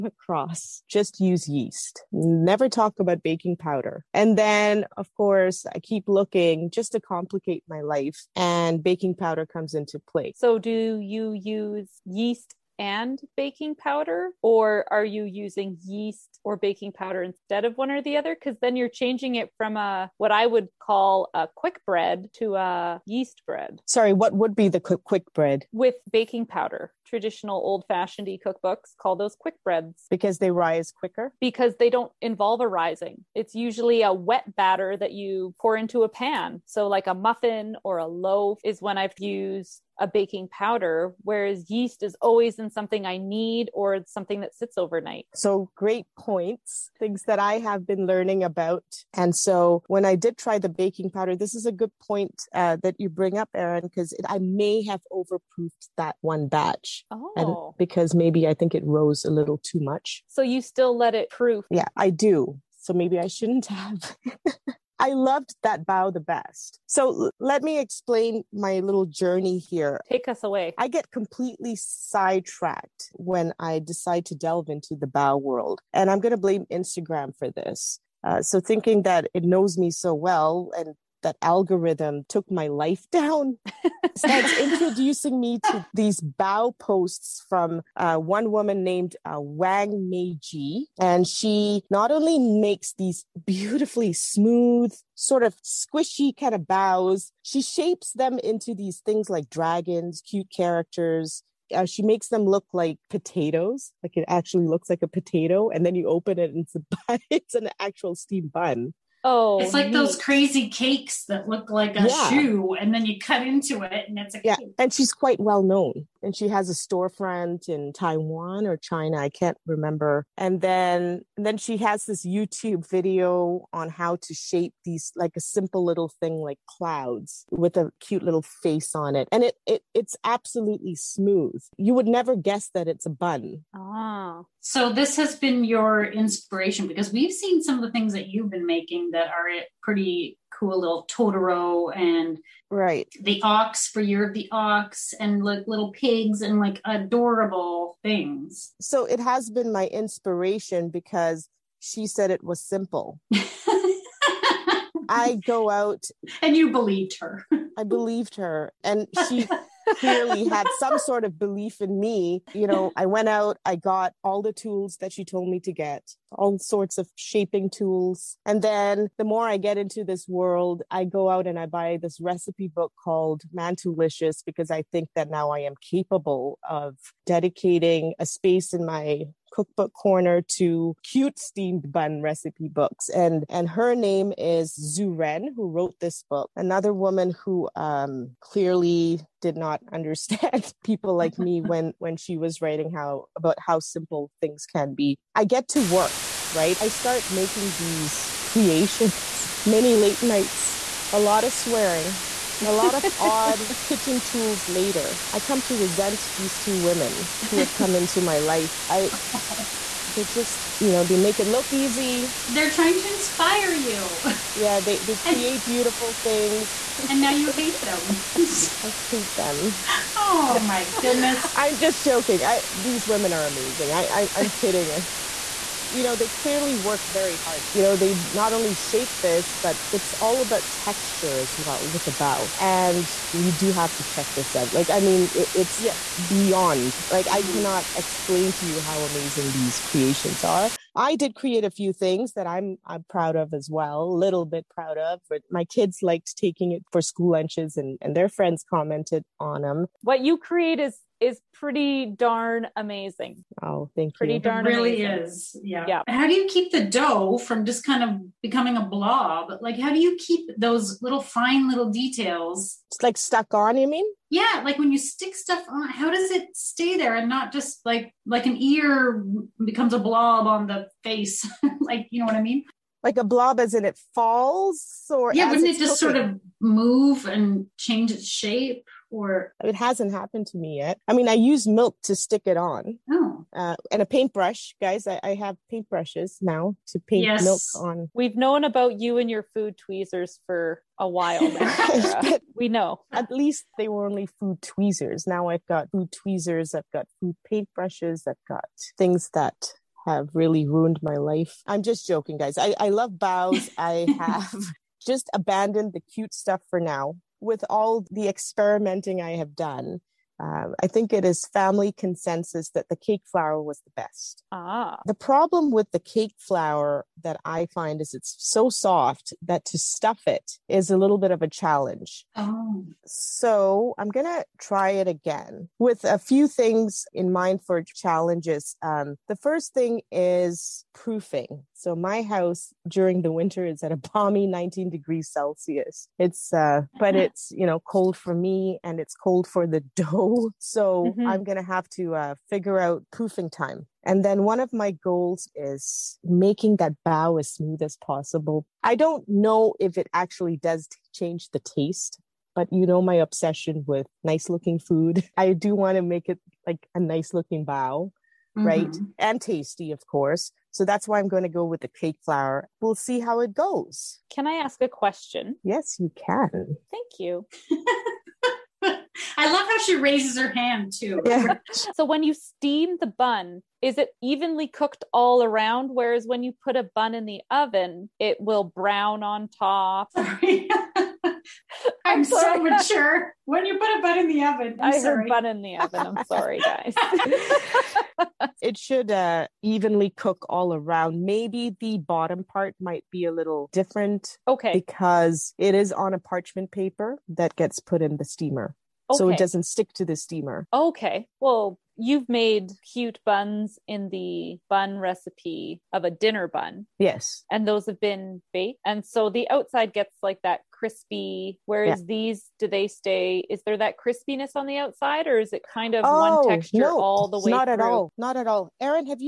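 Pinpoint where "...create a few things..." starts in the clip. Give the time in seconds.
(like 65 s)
241 s.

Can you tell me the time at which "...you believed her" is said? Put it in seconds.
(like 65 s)
156 s.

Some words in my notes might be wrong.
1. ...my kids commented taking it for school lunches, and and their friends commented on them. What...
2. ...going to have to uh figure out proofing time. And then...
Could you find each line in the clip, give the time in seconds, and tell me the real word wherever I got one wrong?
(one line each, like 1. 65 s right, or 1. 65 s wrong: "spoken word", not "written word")
1. 245 s wrong: "liked", not "commented"
2. 341 s right.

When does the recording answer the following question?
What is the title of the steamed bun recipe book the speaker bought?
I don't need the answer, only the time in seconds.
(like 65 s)
173 s.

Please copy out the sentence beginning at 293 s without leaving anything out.
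At least they were only food tweezers.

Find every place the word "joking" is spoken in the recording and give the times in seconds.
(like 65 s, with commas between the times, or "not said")
222 s, 302 s.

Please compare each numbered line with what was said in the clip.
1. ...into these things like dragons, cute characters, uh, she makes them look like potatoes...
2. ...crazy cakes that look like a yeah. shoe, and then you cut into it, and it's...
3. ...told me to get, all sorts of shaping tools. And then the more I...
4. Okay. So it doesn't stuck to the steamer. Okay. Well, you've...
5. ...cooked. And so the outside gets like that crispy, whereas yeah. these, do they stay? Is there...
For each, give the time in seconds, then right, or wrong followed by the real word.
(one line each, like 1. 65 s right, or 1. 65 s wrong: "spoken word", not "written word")
1. 98 s right
2. 110 s right
3. 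165 s right
4. 399 s wrong: "stick", not "stuck"
5. 408 s wrong: "baked", not "cooked".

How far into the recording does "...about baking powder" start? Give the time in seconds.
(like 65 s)
2 s.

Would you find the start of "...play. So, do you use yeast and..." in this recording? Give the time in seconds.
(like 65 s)
10 s.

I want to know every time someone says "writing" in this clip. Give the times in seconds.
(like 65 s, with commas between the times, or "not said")
192 s.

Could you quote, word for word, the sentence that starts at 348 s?
I don't know if it actually does change the taste but you know my obsession with nice looking food.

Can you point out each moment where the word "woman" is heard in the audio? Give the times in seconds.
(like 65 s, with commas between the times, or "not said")
88 s, 186 s.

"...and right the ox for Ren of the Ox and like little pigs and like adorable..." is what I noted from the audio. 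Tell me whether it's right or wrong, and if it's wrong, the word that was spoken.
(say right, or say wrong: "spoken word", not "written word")
wrong: "Year", not "Ren".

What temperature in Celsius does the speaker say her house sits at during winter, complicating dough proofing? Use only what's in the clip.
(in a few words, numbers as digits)
19 degrees Celsius.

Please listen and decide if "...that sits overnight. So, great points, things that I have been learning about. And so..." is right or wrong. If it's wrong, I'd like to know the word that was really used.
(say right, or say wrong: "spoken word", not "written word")
right.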